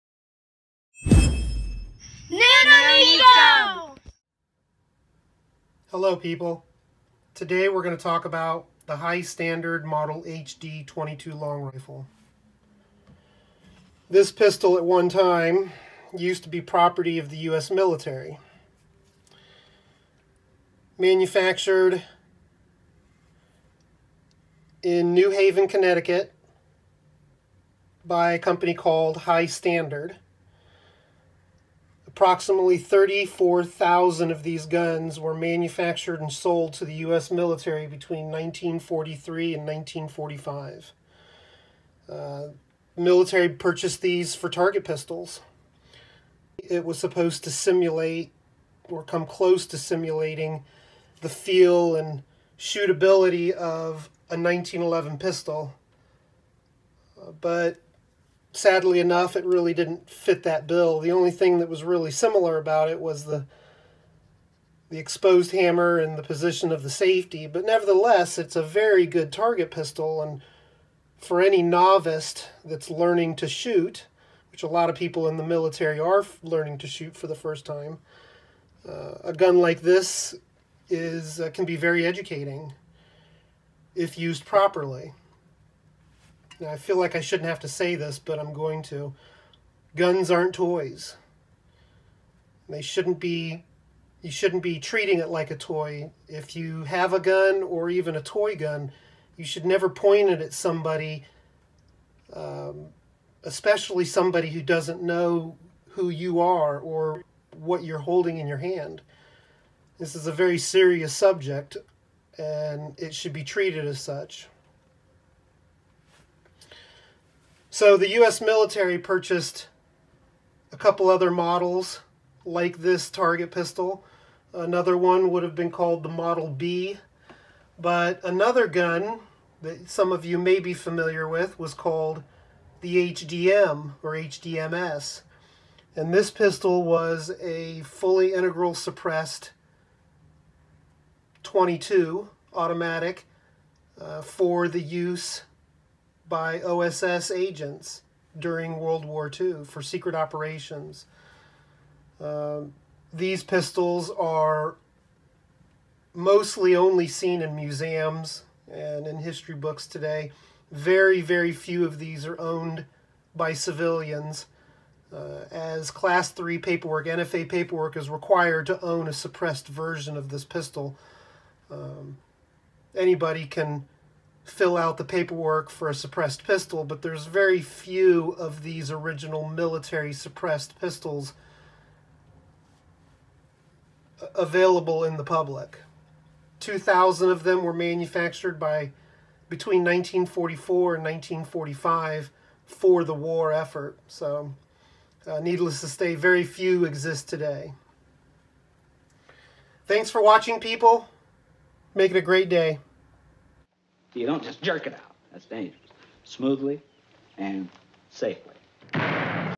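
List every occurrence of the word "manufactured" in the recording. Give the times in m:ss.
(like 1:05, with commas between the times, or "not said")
0:20, 0:35, 3:07.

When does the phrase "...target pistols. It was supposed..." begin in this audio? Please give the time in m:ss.
0:44.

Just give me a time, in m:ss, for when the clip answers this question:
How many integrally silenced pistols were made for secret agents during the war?
3:06.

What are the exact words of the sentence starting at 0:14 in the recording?
This pistol at one time used to be property of the US military.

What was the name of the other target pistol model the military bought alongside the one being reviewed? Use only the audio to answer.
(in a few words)
Model B.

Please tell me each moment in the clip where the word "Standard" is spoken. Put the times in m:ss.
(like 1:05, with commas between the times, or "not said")
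0:09, 0:29.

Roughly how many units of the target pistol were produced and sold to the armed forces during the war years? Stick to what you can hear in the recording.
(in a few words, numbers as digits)
34,000.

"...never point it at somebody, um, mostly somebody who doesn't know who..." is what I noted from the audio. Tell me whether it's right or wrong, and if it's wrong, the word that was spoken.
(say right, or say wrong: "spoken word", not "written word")
wrong: "especially", not "mostly".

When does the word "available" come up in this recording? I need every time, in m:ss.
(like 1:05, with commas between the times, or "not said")
3:04.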